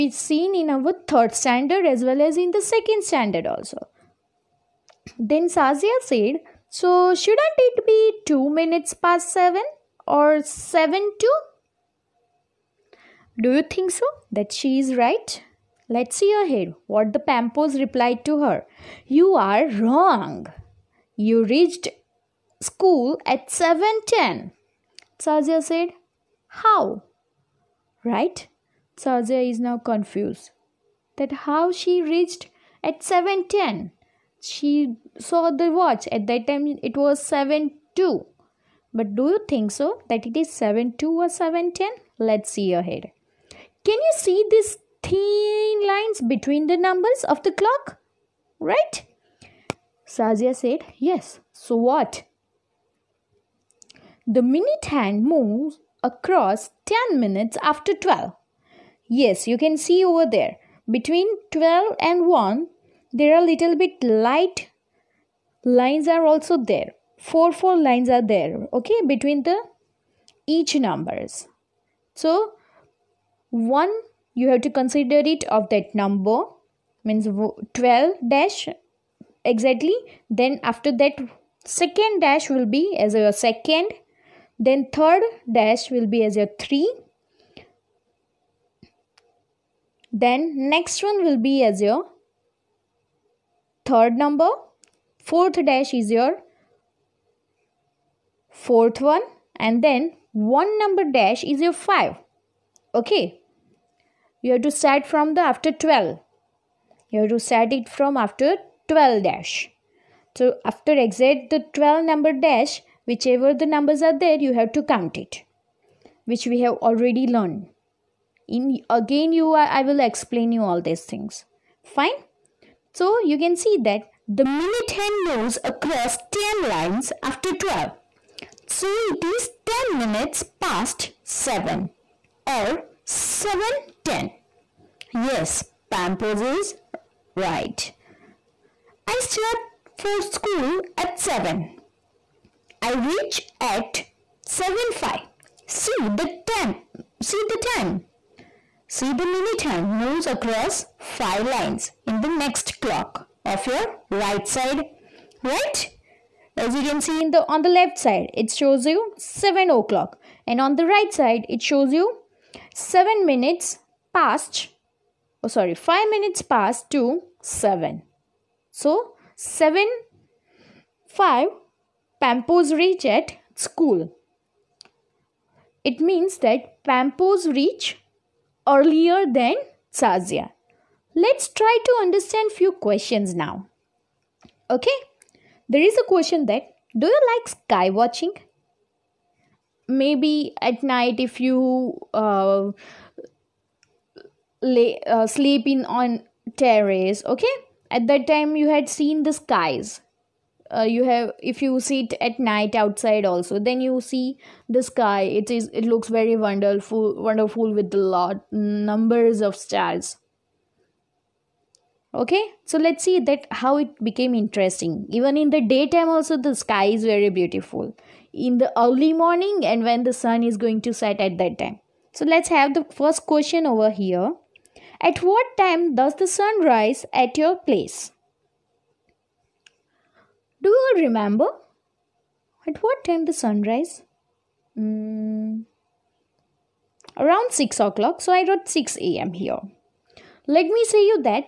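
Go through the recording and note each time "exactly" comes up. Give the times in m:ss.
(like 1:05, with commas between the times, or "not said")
1:19.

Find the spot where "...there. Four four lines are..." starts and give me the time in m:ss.
1:06.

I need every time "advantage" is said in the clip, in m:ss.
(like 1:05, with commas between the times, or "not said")
not said.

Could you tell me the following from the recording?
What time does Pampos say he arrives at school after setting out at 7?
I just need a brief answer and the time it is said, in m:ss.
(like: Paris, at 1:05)
7:05, at 2:24.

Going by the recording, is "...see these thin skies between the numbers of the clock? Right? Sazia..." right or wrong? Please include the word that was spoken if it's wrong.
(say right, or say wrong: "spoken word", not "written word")
wrong: "lines", not "skies".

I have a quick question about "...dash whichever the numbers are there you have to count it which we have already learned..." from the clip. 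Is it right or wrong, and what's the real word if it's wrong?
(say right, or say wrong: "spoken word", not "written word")
right.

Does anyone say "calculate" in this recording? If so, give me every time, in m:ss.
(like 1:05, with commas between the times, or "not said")
not said.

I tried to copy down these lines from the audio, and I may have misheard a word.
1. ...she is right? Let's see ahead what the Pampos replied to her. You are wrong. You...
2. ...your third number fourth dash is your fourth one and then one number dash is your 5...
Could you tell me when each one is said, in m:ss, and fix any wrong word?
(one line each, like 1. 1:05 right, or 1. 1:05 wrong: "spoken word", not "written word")
1. 0:14 right
2. 1:31 right.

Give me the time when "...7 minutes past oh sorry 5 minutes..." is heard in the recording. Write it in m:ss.
2:42.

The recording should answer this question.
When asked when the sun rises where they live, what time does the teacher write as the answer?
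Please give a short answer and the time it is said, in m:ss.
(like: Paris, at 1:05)
6 a.m., at 3:58.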